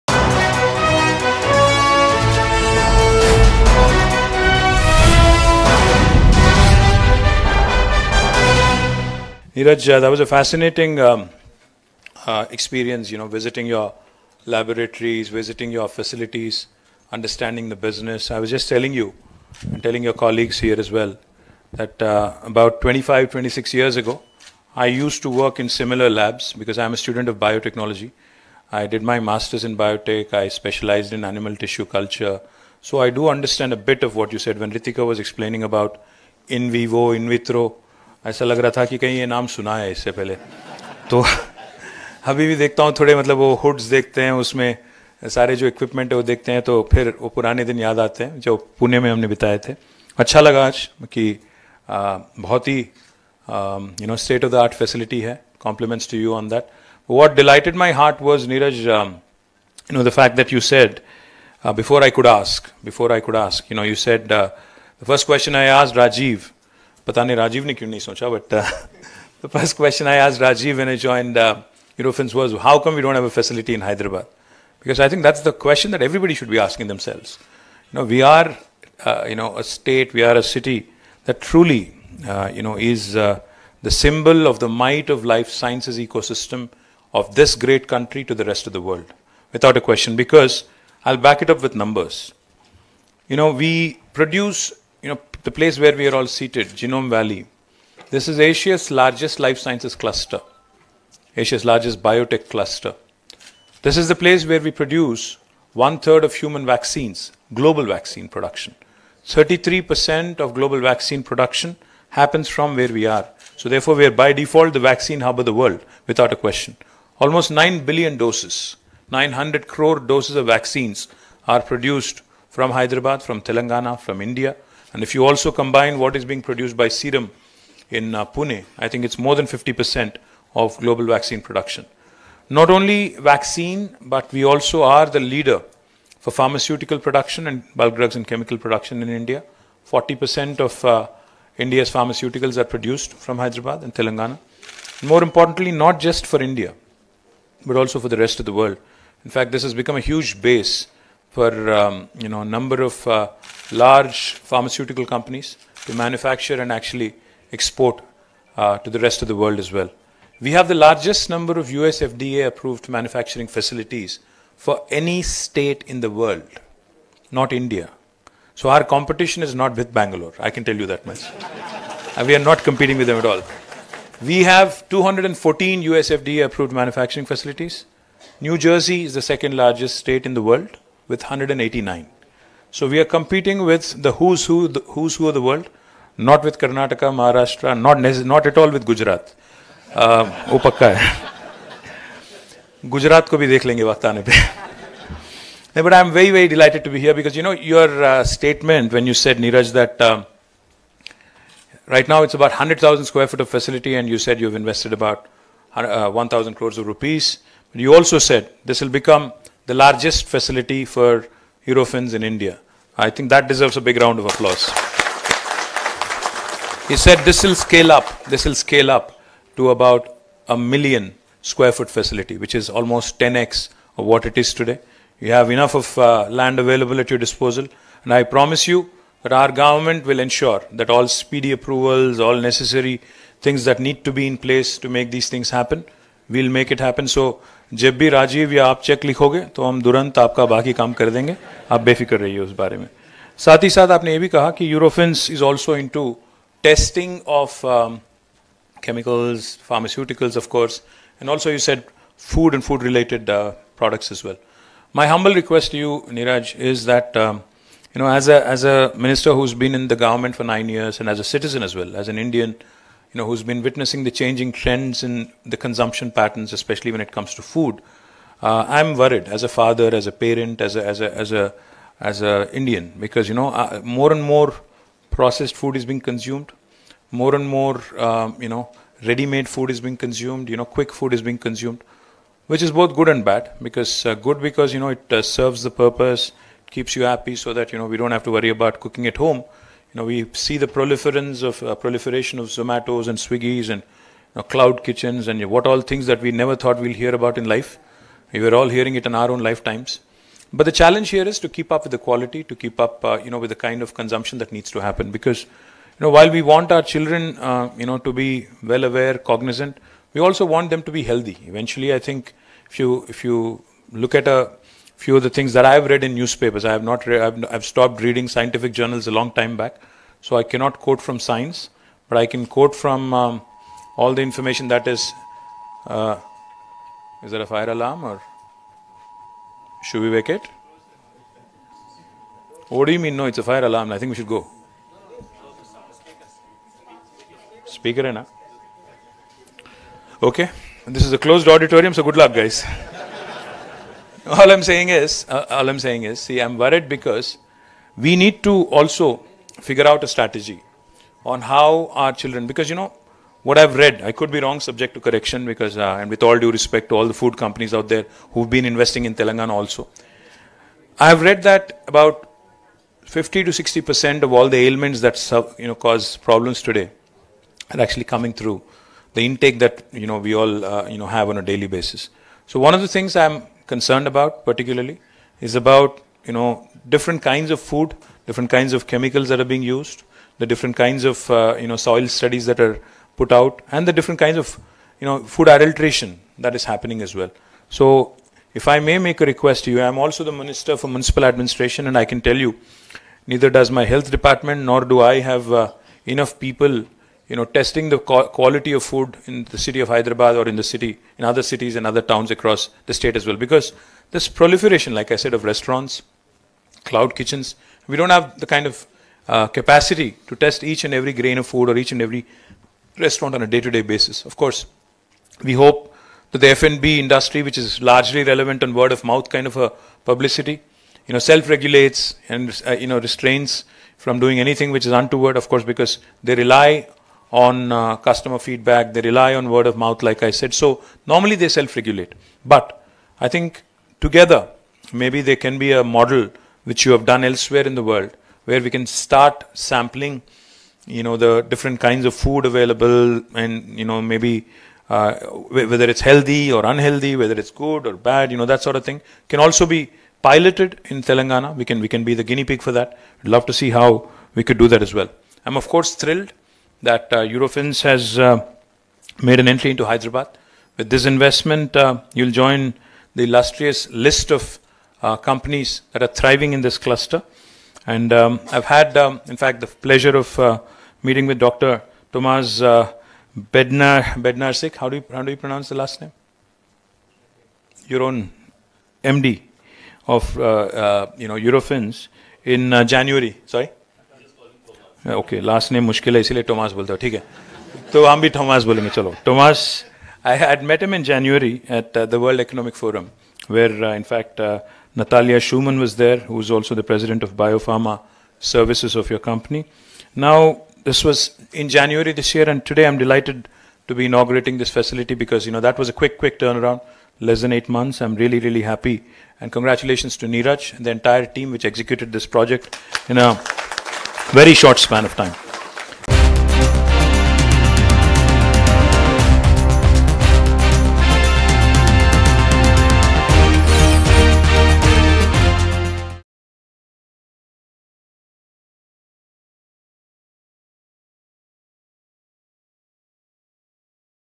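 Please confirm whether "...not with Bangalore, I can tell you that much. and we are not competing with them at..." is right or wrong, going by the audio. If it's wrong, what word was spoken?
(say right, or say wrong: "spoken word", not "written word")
right.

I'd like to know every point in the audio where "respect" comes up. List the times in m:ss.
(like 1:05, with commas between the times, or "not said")
5:56.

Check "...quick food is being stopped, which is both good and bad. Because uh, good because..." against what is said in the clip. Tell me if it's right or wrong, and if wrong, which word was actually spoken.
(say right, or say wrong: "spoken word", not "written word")
wrong: "consumed", not "stopped".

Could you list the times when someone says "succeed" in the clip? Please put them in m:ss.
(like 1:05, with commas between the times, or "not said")
not said.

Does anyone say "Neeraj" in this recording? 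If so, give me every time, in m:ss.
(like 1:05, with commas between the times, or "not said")
0:09, 8:30.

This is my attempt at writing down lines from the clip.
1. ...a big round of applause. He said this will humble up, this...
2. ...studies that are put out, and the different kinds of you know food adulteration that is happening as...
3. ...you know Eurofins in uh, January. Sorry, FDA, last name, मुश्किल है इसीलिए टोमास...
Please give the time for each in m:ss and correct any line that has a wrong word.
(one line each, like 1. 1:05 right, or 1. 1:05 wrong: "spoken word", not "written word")
1. 3:33 wrong: "scale", not "humble"
2. 6:22 right
3. 8:01 wrong: "Okay", not "FDA".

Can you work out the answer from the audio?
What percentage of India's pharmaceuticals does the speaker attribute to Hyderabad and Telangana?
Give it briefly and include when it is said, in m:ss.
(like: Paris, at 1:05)
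40%, at 2:19.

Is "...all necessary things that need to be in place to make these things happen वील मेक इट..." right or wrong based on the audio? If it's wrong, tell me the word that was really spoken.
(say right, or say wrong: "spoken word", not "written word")
right.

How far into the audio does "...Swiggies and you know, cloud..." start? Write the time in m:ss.
4:53.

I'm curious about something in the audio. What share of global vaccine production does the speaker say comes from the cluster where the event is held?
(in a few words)
33%.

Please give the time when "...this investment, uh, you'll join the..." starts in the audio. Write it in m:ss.
7:40.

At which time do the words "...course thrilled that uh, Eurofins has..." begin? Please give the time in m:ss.
7:35.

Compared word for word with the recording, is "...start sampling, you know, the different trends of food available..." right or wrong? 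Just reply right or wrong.
wrong.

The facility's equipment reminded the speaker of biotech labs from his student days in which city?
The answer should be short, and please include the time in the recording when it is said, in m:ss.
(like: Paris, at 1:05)
Pune, at 0:48.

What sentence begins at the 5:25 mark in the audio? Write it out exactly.
Uh, is there a fire alarm or should we wake it?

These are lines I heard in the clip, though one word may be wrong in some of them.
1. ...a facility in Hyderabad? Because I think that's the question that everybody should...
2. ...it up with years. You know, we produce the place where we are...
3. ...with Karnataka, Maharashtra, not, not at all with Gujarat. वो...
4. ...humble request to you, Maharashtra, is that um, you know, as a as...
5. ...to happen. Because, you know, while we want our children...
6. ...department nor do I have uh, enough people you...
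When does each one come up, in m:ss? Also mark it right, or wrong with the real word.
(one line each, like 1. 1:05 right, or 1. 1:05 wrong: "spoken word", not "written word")
1. 1:13 right
2. 1:31 wrong: "numbers", not "years"
3. 3:06 right
4. 4:15 wrong: "Niraj", not "Maharashtra"
5. 5:04 right
6. 6:34 right.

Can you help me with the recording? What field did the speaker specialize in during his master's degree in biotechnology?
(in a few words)
Animal tissue culture.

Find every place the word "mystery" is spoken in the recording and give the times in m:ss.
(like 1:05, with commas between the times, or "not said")
not said.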